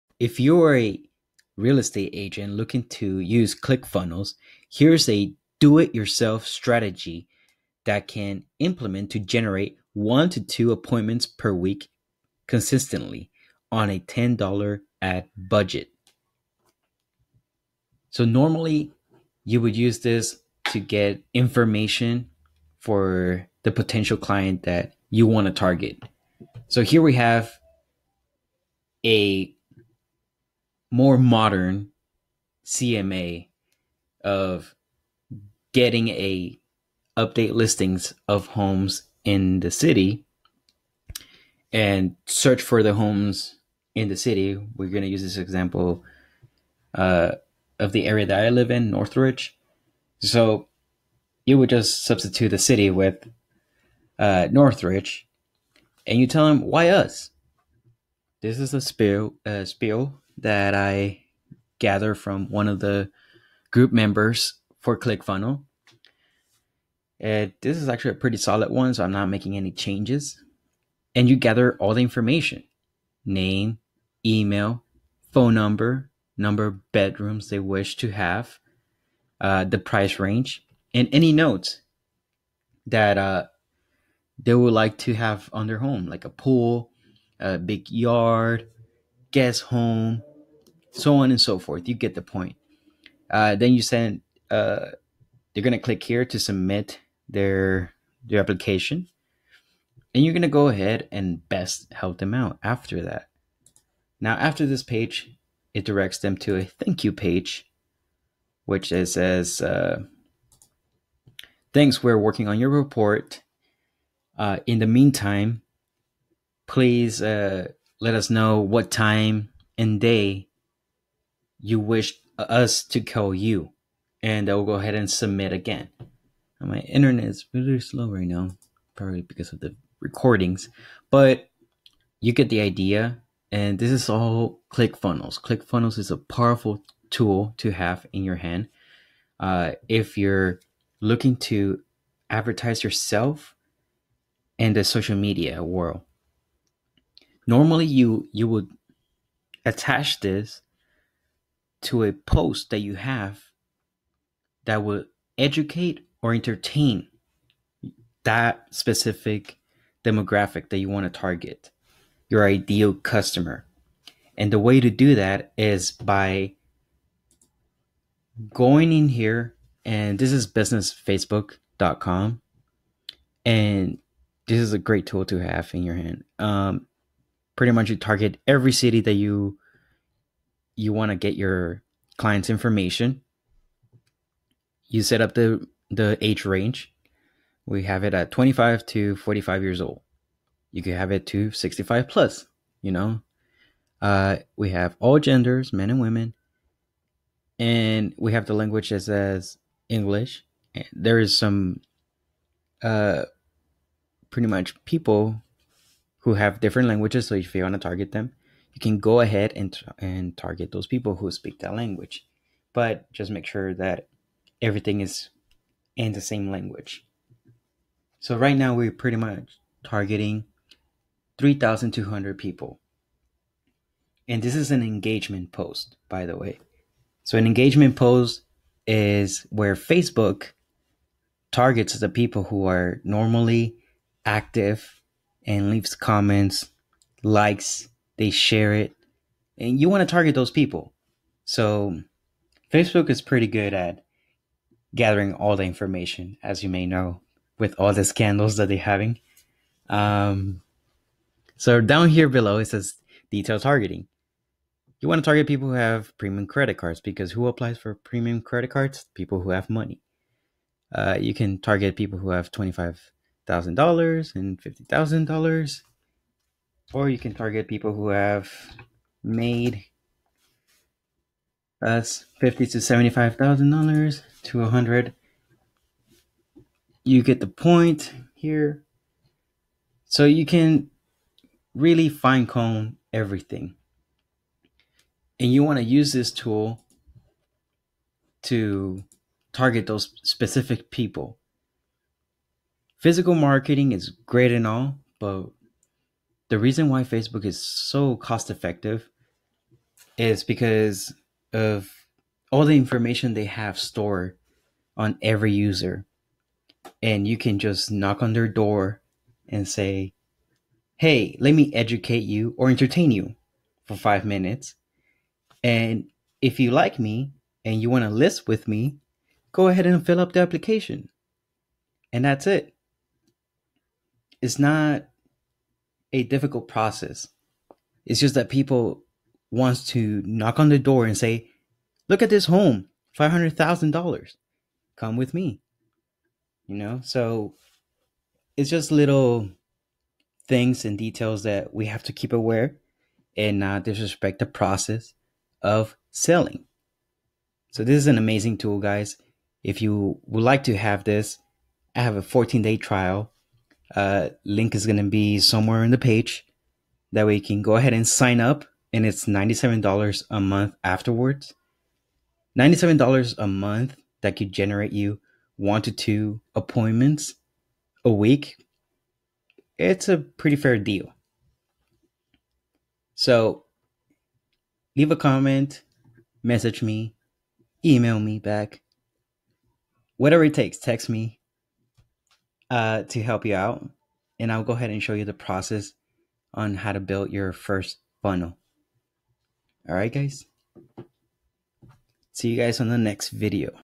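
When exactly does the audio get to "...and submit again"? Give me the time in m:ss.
2:04.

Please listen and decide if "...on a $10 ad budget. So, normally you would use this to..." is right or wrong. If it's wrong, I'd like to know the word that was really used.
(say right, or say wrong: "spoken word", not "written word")
right.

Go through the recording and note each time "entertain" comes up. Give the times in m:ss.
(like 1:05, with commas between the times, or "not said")
2:36, 5:12.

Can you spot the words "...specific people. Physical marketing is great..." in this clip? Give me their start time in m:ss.
4:50.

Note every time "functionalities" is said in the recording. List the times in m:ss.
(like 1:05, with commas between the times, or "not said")
not said.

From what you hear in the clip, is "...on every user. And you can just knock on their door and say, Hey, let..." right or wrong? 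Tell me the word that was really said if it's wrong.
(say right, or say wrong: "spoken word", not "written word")
right.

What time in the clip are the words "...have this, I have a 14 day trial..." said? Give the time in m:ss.
5:50.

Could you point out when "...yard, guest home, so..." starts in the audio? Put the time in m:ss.
1:27.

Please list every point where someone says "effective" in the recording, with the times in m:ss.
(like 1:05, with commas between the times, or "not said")
4:58.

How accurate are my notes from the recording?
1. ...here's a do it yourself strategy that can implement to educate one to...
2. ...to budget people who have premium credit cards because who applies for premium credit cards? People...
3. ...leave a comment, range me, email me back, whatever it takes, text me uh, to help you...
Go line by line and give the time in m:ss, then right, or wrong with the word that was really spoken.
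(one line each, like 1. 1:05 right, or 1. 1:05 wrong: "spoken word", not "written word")
1. 0:04 wrong: "generate", not "educate"
2. 4:15 wrong: "target", not "budget"
3. 6:14 wrong: "message", not "range".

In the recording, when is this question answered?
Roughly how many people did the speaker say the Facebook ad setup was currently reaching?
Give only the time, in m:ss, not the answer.
3:41.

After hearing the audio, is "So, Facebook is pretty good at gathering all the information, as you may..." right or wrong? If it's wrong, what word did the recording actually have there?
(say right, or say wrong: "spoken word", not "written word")
right.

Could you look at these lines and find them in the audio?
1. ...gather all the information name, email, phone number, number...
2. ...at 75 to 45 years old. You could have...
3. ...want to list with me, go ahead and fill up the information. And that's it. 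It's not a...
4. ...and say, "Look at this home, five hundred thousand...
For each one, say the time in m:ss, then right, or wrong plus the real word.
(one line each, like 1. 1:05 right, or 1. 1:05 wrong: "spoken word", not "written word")
1. 1:11 right
2. 3:08 wrong: "25", not "75"
3. 5:17 wrong: "application", not "information"
4. 5:31 right.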